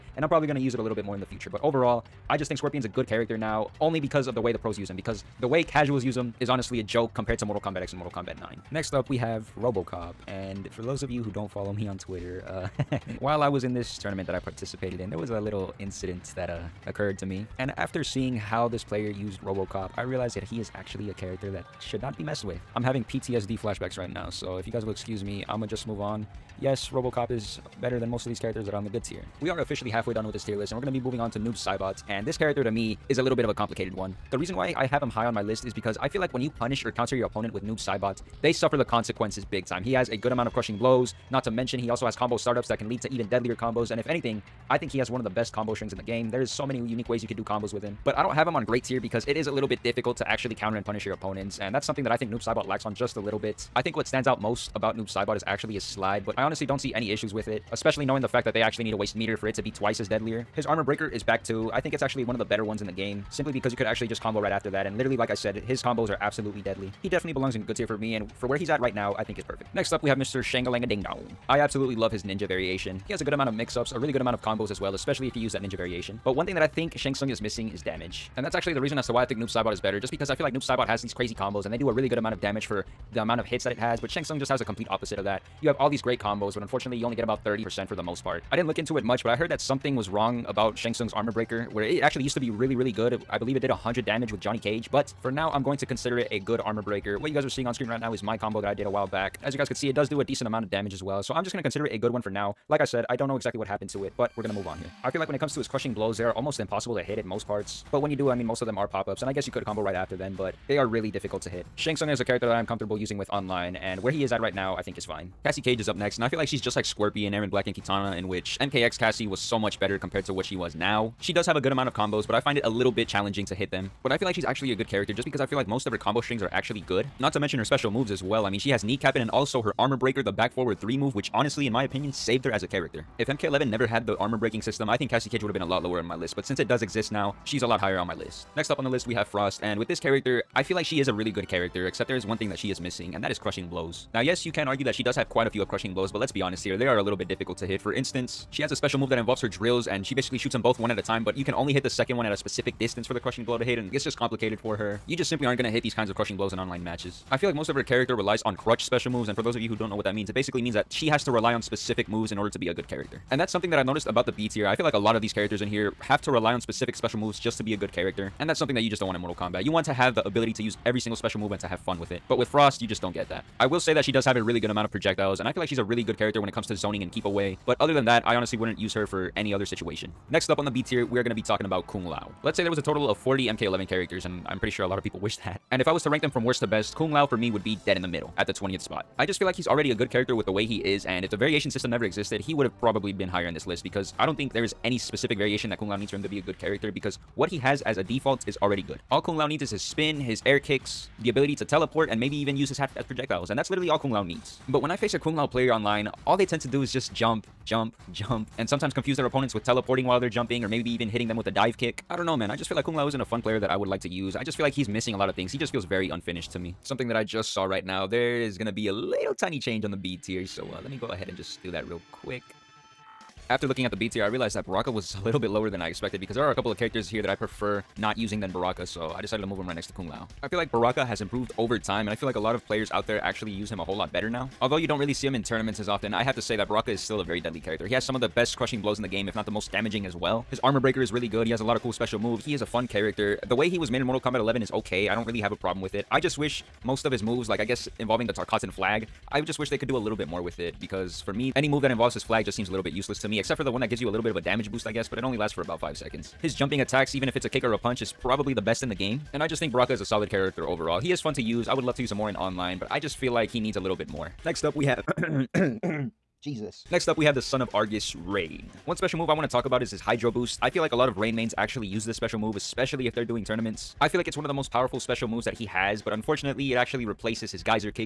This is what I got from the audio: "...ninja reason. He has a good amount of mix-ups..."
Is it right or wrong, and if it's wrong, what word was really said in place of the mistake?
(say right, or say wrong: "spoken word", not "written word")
wrong: "variation", not "reason".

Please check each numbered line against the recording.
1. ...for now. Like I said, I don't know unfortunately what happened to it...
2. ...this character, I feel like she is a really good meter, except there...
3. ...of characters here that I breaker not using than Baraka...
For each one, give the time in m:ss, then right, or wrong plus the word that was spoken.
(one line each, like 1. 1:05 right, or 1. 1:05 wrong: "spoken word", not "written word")
1. 1:42 wrong: "exactly", not "unfortunately"
2. 2:19 wrong: "character", not "meter"
3. 3:46 wrong: "prefer", not "breaker".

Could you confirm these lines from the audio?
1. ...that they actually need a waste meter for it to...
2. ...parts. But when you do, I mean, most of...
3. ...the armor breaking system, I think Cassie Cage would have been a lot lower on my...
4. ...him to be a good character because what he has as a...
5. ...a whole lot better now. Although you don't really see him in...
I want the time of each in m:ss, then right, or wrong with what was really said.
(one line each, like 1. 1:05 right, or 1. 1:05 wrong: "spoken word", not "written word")
1. 0:58 right
2. 1:47 right
3. 2:14 right
4. 3:16 right
5. 3:53 right.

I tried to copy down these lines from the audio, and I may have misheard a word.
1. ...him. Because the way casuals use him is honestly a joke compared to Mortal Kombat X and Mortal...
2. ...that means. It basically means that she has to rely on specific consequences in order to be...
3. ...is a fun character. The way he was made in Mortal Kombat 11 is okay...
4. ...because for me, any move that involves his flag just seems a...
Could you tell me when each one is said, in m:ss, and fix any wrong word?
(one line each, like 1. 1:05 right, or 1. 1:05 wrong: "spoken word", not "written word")
1. 0:04 right
2. 2:40 wrong: "moves", not "consequences"
3. 4:02 right
4. 4:10 right.